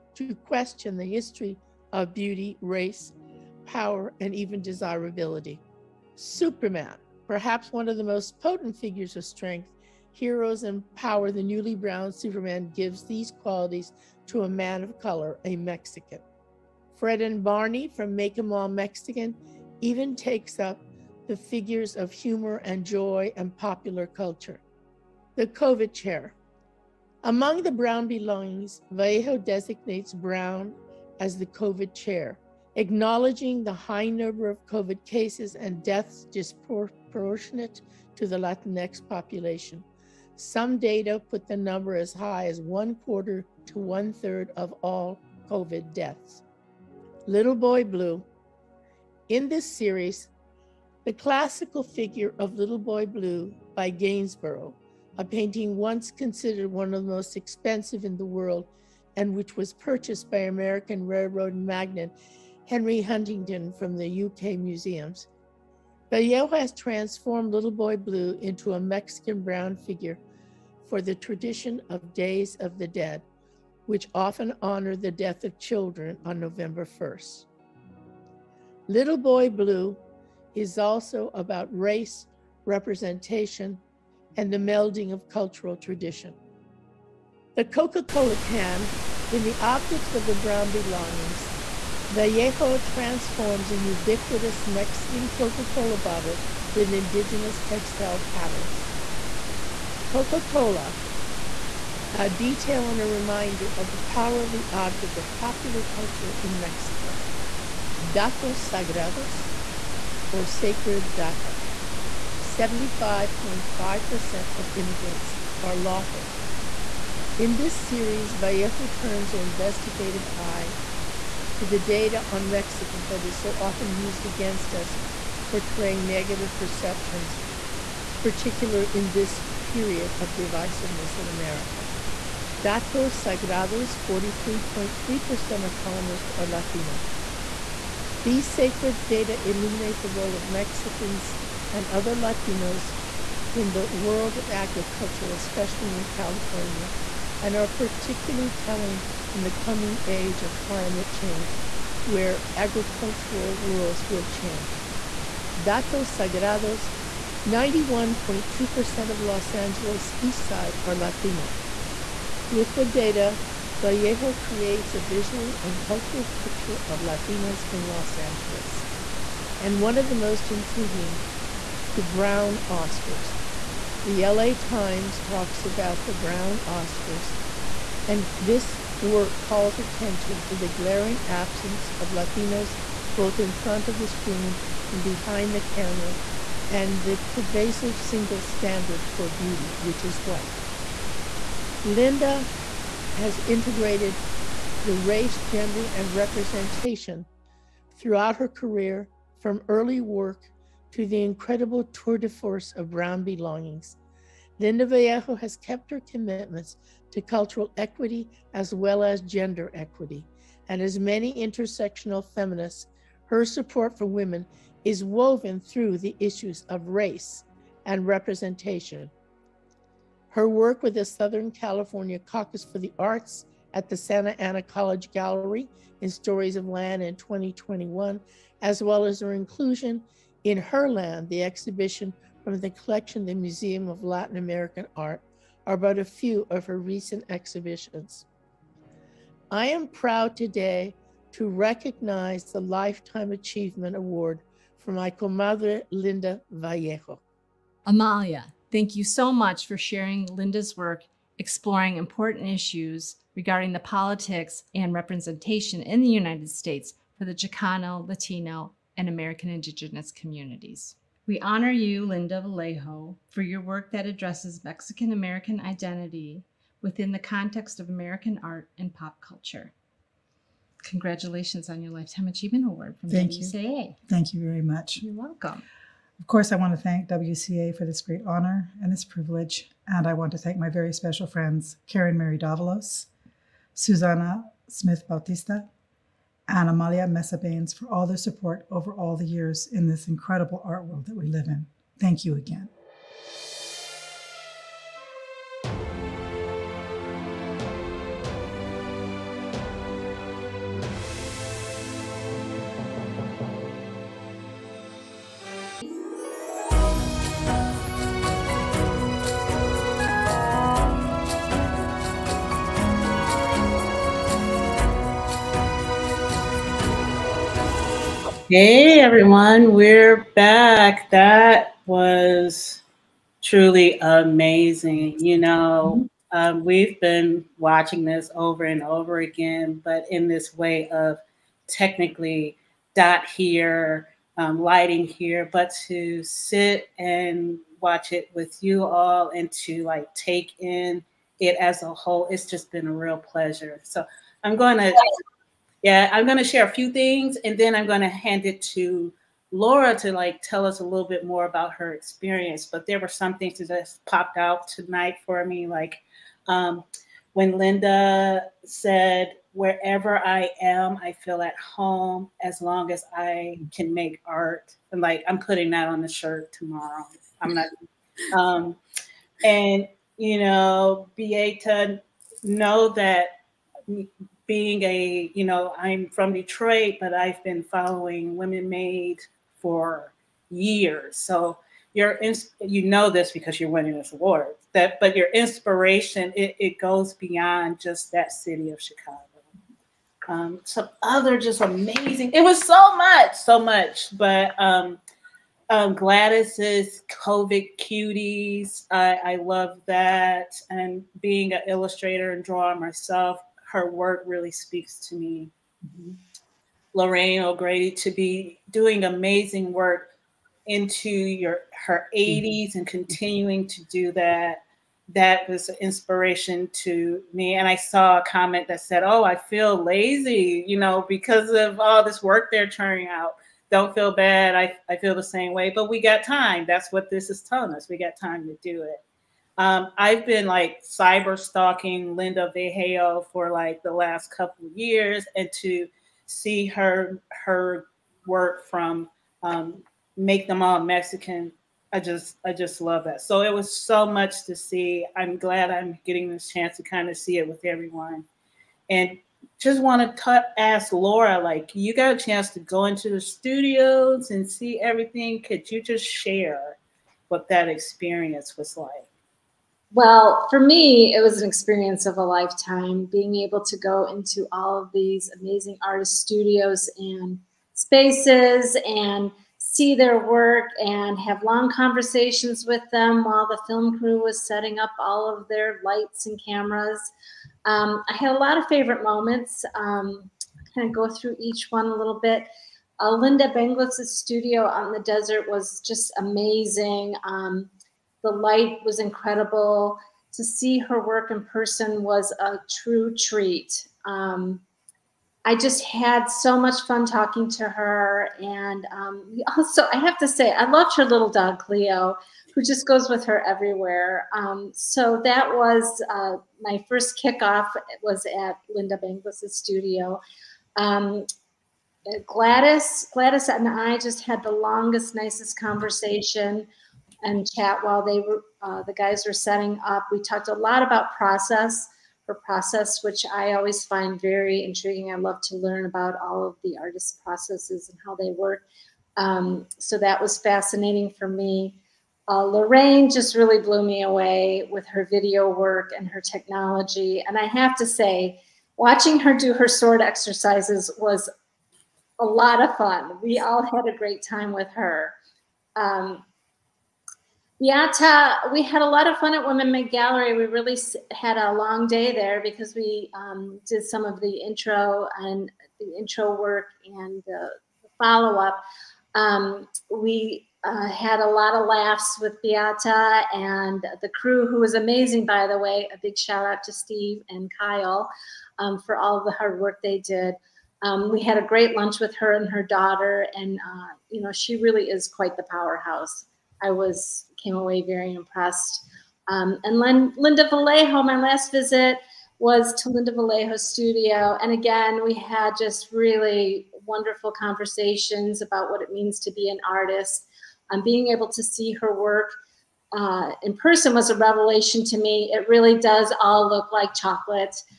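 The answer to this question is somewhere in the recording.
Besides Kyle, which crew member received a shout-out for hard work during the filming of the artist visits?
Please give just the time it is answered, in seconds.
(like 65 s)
566 s.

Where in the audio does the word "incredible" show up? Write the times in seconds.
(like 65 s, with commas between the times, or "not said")
201 s, 290 s, 488 s.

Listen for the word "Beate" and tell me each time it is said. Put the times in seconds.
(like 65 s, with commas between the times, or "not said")
371 s, 562 s.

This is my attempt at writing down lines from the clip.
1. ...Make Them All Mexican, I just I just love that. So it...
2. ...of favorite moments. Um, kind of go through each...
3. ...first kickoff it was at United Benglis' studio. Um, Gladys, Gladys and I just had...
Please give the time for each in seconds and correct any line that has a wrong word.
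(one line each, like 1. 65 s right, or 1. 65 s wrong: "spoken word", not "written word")
1. 440 s right
2. 478 s right
3. 506 s wrong: "Lynda", not "United".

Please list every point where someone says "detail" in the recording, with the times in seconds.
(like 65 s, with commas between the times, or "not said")
102 s.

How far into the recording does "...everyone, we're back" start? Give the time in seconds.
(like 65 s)
318 s.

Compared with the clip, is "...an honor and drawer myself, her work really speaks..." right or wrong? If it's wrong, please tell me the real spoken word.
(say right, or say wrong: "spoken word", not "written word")
wrong: "illustrator", not "honor".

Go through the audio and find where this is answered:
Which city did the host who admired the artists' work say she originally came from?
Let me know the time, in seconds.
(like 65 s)
376 s.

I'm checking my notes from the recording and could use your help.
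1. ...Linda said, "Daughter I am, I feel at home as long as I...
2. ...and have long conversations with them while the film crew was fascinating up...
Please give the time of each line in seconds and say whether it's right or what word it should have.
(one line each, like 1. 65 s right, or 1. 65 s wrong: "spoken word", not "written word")
1. 357 s wrong: "Wherever", not "Daughter"
2. 470 s wrong: "setting", not "fascinating".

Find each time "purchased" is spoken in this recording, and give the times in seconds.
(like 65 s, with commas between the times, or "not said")
59 s.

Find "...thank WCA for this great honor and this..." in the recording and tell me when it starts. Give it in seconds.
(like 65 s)
276 s.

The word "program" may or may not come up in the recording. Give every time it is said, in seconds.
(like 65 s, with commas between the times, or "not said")
not said.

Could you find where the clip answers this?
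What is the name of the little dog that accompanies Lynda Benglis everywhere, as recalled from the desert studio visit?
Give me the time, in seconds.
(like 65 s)
501 s.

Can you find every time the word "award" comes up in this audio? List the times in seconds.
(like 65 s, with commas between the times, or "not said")
243 s, 272 s, 384 s.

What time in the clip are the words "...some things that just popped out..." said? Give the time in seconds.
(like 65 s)
353 s.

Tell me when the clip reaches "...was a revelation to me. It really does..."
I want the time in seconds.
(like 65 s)
593 s.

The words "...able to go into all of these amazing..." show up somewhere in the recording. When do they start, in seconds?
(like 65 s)
463 s.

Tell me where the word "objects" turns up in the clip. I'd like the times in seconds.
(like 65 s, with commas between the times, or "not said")
89 s, 104 s.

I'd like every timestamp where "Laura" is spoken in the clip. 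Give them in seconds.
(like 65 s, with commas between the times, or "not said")
349 s, 450 s.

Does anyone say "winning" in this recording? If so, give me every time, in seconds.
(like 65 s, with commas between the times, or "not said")
383 s.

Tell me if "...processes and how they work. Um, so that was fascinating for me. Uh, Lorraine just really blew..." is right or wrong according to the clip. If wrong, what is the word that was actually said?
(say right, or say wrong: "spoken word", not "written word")
right.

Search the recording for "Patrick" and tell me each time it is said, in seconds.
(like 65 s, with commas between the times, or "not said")
not said.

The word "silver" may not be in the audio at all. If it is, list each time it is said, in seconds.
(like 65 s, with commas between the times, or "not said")
not said.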